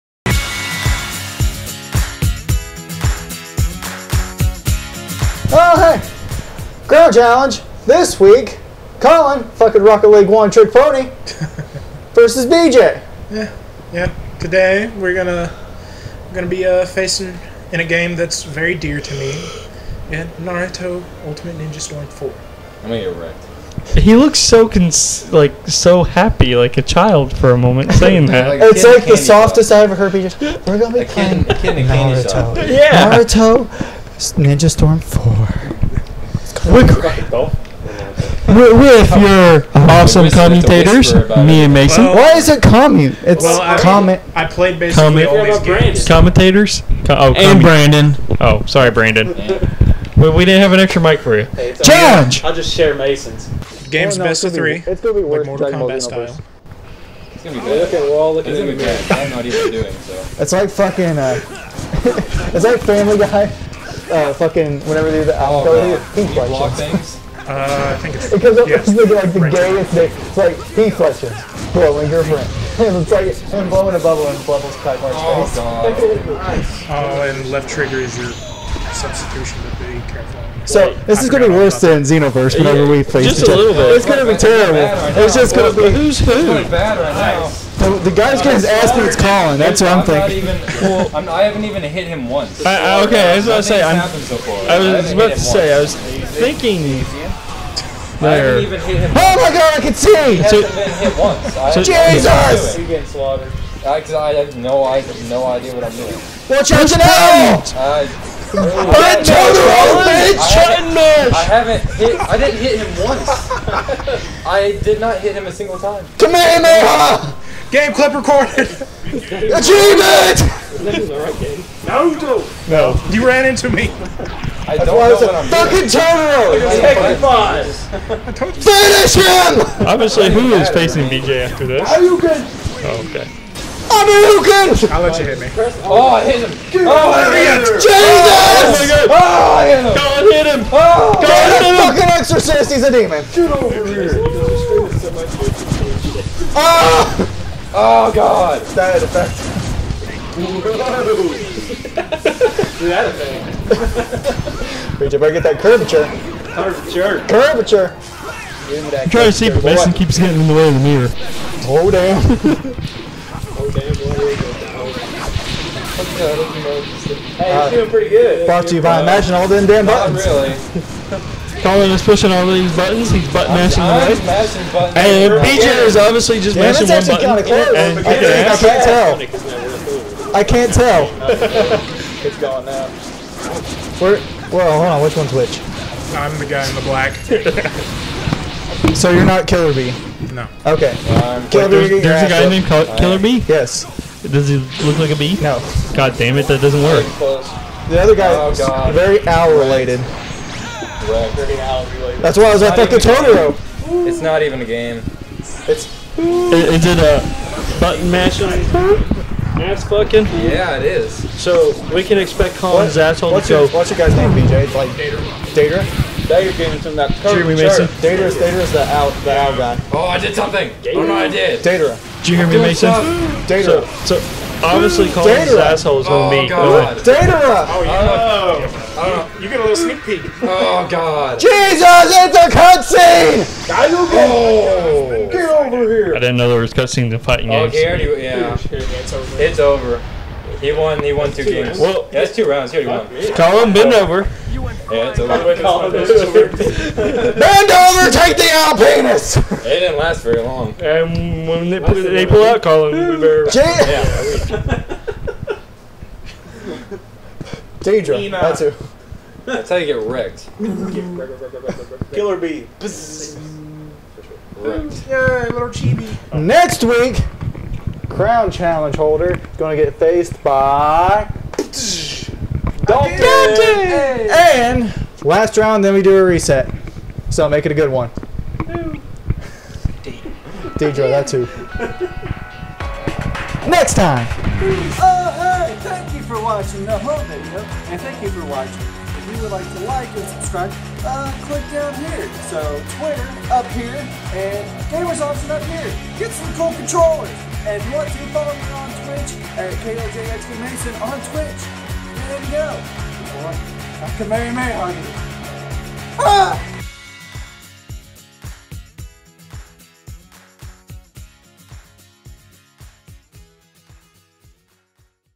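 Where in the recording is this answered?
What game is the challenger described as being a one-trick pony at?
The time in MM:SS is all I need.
00:09.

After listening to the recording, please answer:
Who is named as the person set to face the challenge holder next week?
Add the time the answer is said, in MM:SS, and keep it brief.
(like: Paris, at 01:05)
Dalton, at 04:32.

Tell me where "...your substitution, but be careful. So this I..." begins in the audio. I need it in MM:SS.
01:18.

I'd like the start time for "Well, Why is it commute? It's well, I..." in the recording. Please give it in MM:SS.
00:42.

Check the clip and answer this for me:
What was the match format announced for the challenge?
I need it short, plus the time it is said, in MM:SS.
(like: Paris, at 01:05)
Best of three, at 00:54.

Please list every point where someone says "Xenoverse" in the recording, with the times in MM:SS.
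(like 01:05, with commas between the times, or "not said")
00:55, 01:22.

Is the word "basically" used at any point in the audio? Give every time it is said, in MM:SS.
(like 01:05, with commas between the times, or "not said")
00:44.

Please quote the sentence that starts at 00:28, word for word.
Like it's like the softest I ever heard.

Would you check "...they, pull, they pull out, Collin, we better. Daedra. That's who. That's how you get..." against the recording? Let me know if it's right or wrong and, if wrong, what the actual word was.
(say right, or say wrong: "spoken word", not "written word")
right.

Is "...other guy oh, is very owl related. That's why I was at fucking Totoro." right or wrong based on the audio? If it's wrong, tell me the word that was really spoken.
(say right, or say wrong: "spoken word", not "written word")
right.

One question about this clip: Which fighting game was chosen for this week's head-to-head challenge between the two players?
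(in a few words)
Naruto Ultimate Ninja Storm Four.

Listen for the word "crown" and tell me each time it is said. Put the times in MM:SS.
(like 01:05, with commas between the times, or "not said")
00:06, 04:28.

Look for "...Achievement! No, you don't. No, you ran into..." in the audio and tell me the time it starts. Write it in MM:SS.
01:59.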